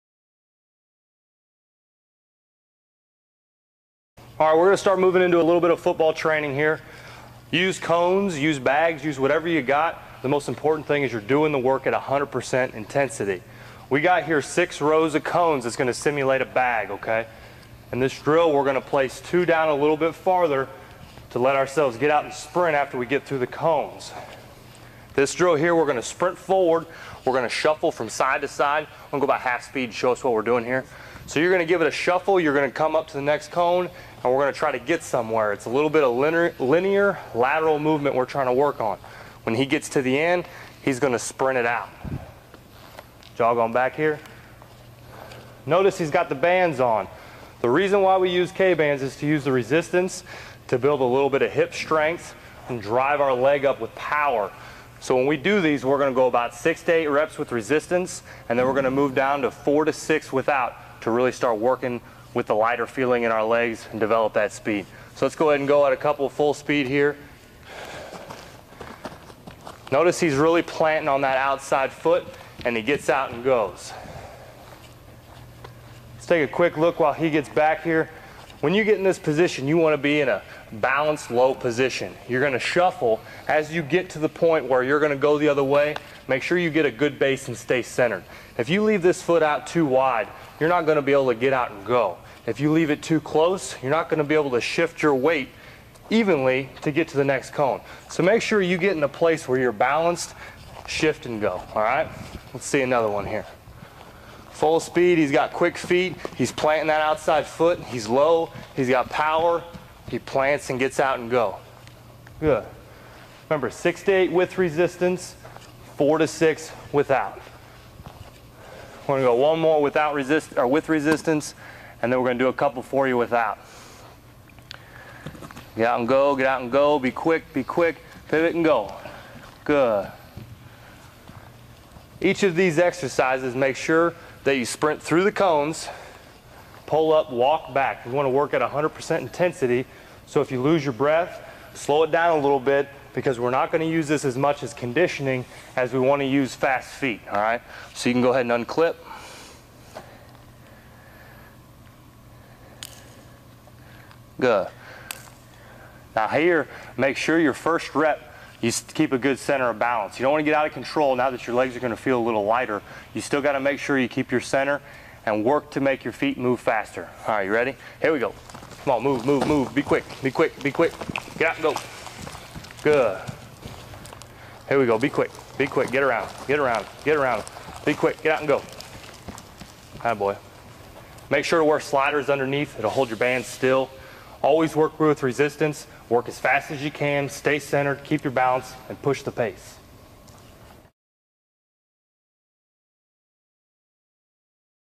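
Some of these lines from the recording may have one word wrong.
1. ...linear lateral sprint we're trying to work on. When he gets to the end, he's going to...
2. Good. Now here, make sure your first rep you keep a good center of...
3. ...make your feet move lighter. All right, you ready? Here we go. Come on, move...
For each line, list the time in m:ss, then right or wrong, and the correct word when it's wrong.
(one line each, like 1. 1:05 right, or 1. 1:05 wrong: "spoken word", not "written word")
1. 0:36 wrong: "movement", not "sprint"
2. 2:34 right
3. 2:45 wrong: "faster", not "lighter".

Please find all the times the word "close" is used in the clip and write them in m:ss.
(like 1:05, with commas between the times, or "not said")
1:33.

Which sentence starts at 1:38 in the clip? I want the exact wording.
So make sure you get in a place where you're balanced, shift and go, all right?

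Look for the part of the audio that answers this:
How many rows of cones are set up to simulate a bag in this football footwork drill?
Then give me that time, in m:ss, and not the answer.
0:14.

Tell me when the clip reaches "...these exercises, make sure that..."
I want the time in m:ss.
2:12.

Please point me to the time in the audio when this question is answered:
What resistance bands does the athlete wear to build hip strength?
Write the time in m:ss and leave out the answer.
0:48.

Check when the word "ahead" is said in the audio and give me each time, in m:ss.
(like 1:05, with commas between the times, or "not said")
1:05, 2:28.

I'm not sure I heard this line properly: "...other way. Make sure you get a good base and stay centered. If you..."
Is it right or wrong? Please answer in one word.
right.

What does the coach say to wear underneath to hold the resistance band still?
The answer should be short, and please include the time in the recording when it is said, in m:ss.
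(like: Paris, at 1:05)
Sliders, at 3:01.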